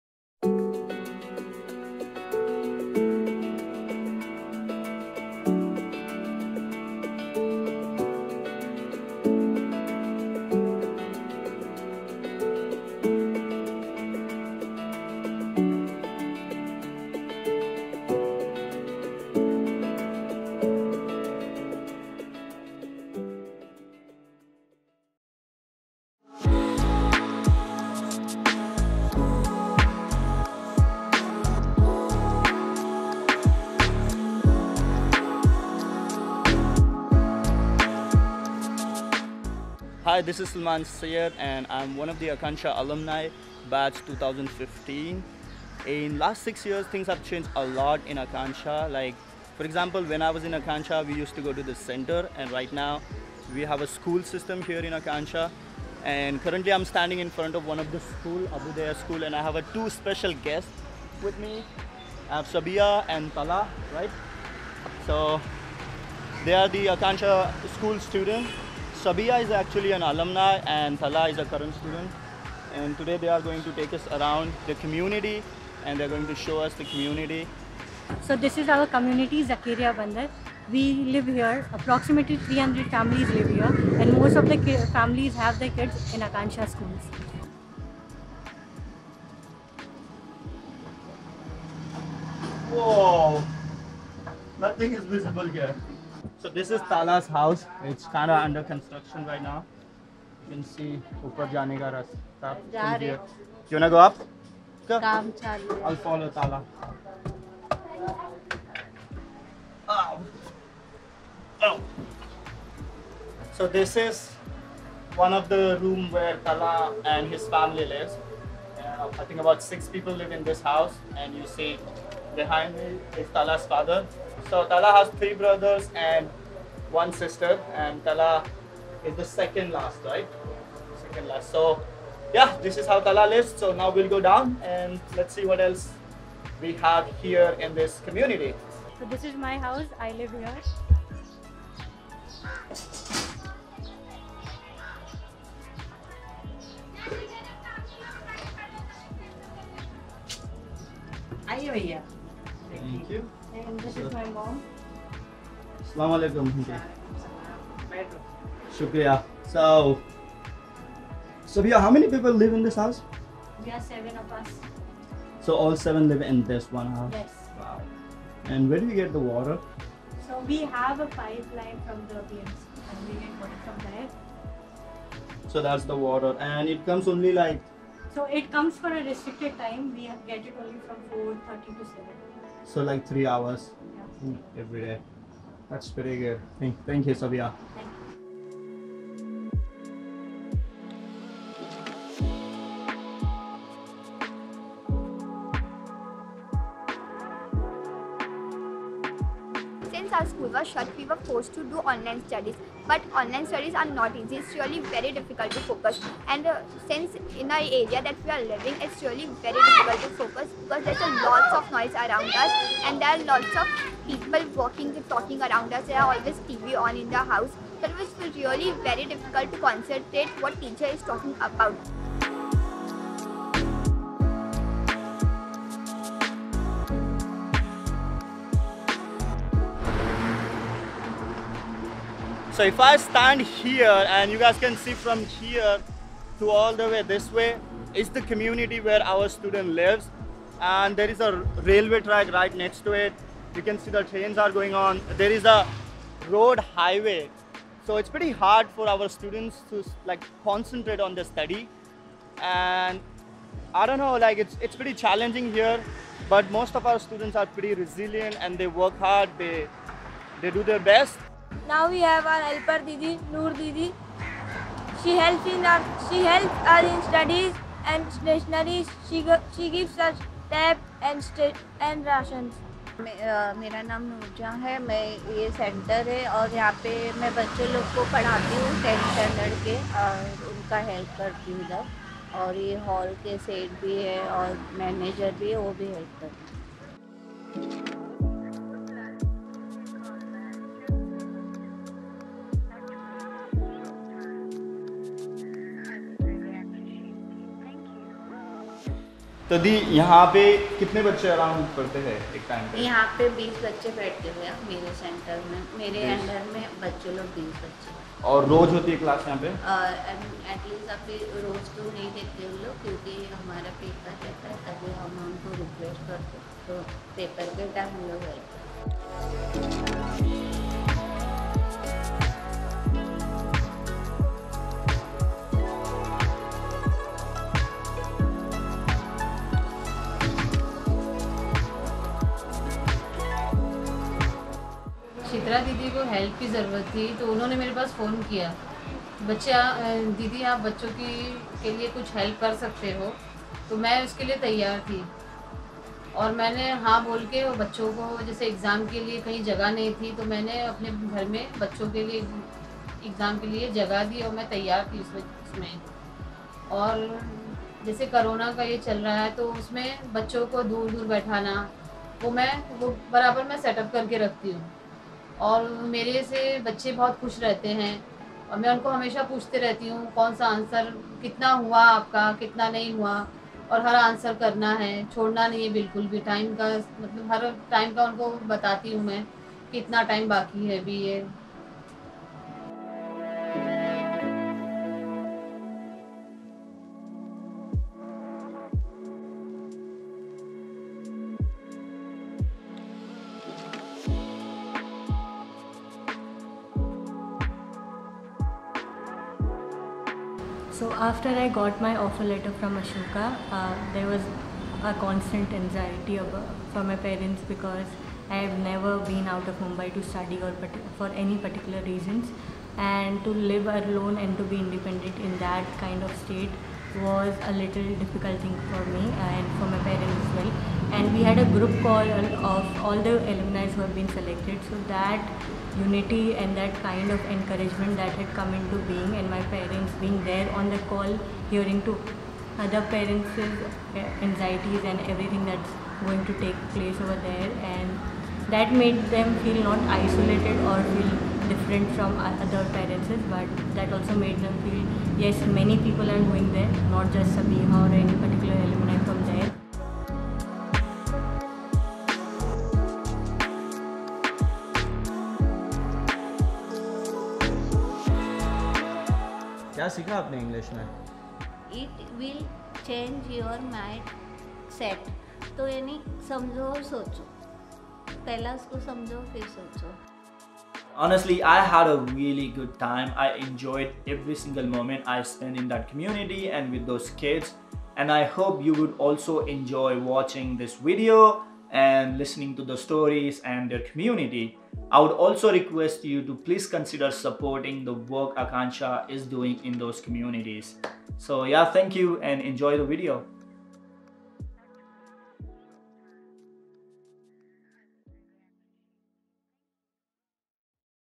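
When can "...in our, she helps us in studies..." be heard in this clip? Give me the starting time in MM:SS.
04:25.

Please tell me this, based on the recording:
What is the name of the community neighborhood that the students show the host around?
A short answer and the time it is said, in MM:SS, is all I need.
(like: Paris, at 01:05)
Zakeriya Bunder, at 01:19.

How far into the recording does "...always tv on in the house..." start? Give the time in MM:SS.
03:36.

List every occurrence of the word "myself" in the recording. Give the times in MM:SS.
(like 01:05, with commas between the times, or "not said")
not said.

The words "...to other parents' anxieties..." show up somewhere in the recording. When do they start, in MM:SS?
07:11.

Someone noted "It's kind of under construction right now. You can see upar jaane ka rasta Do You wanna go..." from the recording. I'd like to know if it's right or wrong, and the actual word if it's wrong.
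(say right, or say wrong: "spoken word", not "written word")
right.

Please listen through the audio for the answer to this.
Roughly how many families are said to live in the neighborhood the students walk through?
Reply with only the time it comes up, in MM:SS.
01:21.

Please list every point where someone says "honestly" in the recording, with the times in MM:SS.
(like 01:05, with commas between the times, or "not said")
07:51.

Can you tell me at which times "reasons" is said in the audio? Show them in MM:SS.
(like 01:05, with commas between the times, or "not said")
06:51.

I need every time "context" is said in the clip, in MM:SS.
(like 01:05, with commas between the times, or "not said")
not said.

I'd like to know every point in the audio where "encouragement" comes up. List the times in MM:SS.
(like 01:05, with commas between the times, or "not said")
07:07.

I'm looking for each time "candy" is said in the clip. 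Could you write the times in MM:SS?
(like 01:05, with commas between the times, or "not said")
not said.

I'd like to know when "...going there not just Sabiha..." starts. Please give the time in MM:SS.
07:26.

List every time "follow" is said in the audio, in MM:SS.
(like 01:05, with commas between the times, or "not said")
01:46.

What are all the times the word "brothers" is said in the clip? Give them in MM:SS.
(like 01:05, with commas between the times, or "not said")
02:05.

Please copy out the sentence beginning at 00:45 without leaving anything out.
In last six years, things have changed a lot in Akanksha.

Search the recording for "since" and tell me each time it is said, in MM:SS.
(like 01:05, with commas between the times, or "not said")
03:19, 03:26.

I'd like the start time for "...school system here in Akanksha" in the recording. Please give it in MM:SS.
00:53.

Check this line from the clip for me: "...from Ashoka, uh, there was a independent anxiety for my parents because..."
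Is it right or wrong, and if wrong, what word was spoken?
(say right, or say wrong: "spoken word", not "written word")
wrong: "constant", not "independent".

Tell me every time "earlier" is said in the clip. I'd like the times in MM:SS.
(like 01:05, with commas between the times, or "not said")
not said.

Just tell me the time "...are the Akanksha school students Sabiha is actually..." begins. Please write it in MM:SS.
01:06.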